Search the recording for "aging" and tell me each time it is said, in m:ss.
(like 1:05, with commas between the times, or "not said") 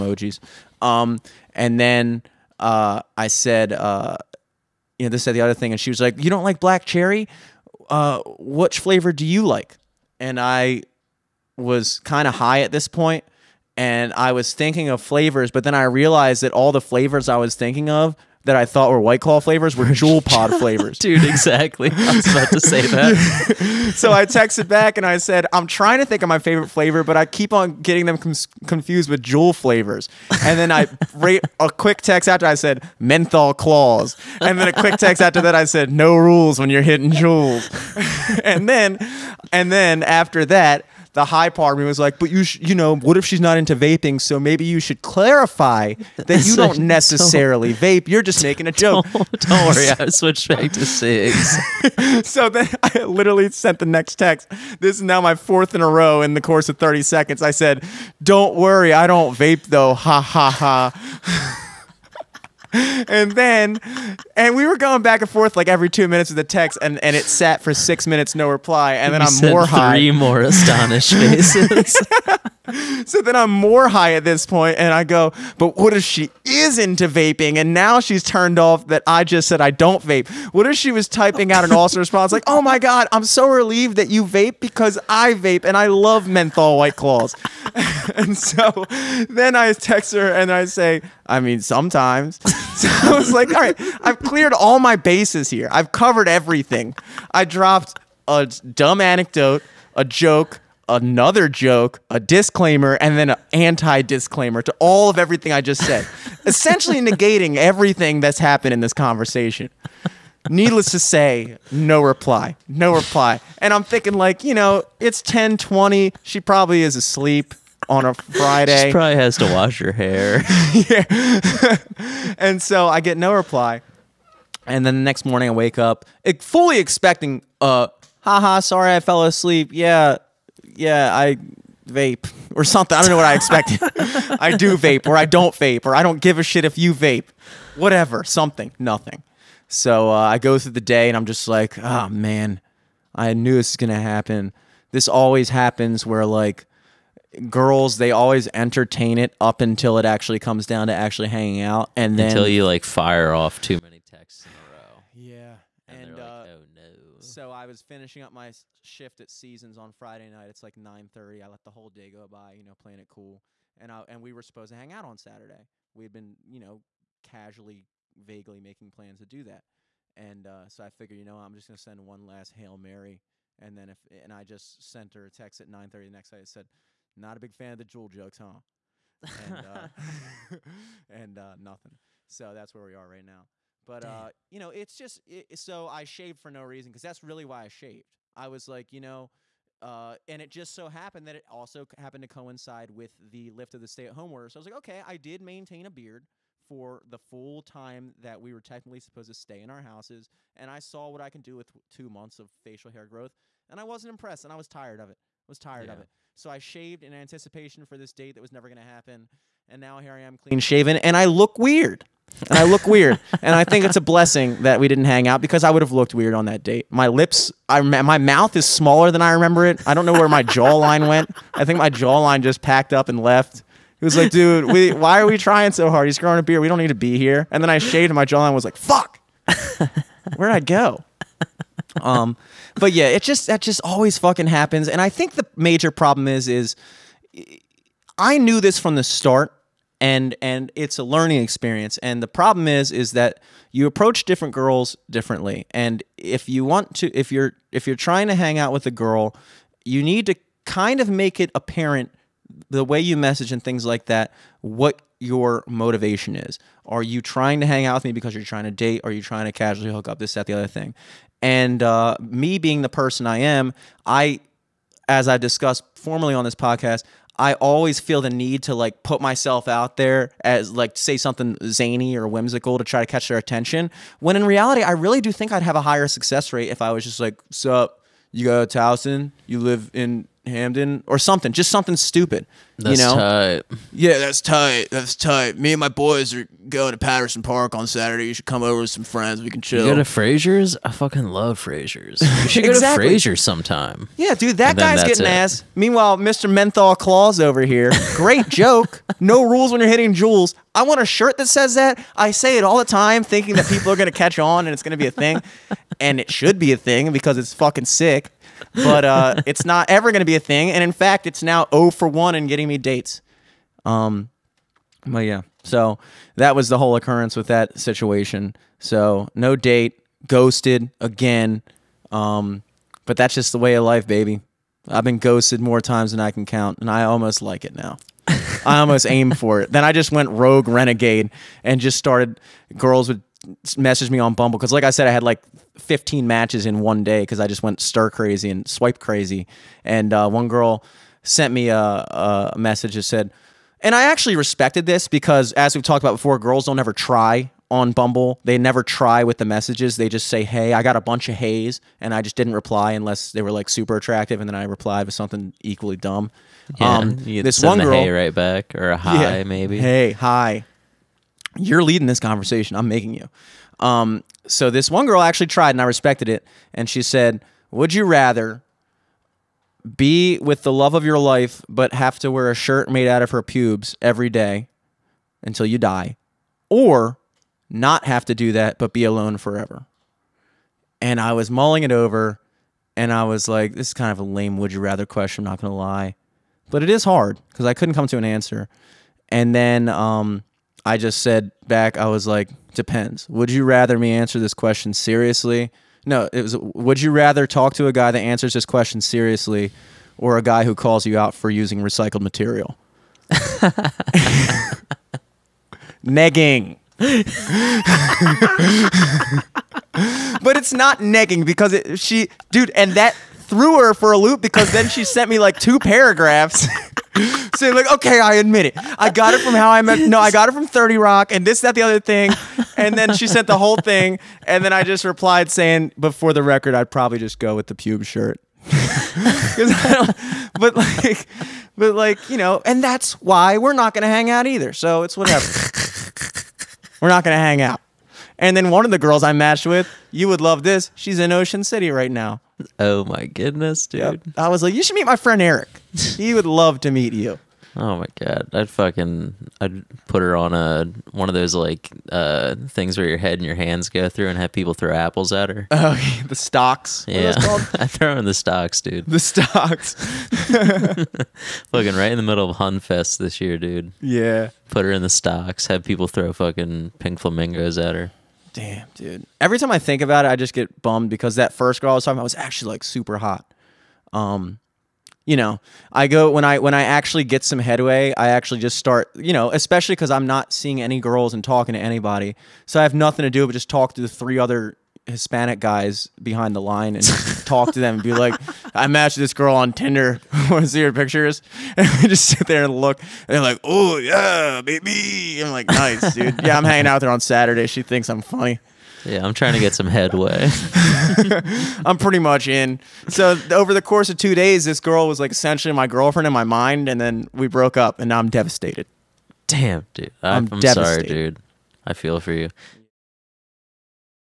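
not said.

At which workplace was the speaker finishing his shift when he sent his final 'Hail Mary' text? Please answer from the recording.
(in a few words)
Seasons.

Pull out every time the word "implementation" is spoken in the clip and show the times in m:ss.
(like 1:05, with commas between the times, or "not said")
not said.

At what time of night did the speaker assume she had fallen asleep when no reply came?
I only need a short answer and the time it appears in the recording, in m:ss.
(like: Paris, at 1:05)
10:20, at 1:55.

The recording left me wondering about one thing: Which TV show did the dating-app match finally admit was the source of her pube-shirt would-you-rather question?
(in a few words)
30 Rock.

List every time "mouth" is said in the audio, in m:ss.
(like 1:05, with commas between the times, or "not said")
3:38.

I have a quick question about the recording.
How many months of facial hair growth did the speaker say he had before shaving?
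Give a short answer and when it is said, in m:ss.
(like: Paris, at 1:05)
2, at 3:21.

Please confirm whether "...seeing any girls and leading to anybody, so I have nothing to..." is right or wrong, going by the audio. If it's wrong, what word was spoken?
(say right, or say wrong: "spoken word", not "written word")
wrong: "talking", not "leading".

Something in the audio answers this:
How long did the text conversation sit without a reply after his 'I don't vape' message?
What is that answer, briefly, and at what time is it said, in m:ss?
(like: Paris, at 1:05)
6 minutes, at 1:07.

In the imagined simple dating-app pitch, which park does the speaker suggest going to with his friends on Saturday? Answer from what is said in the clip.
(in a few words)
Patterson Park.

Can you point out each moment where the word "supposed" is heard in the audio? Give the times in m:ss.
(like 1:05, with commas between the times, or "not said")
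2:44, 3:19.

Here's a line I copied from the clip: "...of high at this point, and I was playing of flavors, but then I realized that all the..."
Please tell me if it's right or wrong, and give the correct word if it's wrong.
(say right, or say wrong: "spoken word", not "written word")
wrong: "thinking", not "playing".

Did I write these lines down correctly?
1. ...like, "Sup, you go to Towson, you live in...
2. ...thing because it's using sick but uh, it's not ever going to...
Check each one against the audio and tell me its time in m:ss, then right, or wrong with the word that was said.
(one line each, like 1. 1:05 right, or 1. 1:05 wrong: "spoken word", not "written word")
1. 4:37 right
2. 5:06 wrong: "fucking", not "using".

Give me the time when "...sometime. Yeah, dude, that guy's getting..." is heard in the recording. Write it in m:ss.
4:53.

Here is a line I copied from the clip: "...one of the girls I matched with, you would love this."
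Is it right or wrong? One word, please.
right.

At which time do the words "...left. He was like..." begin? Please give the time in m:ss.
3:43.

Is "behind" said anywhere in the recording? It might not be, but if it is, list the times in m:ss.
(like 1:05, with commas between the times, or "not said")
8:06.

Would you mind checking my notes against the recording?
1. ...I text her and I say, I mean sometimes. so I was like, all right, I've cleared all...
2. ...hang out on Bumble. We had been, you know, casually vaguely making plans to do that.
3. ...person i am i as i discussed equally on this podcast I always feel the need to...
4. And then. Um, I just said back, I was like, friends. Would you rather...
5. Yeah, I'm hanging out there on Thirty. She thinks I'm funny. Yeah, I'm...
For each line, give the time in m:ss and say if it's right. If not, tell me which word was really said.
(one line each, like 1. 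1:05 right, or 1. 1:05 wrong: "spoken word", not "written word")
1. 1:29 right
2. 2:44 wrong: "Saturday", not "Bumble"
3. 4:22 wrong: "formerly", not "equally"
4. 6:29 wrong: "depends", not "friends"
5. 8:16 wrong: "Saturday", not "Thirty".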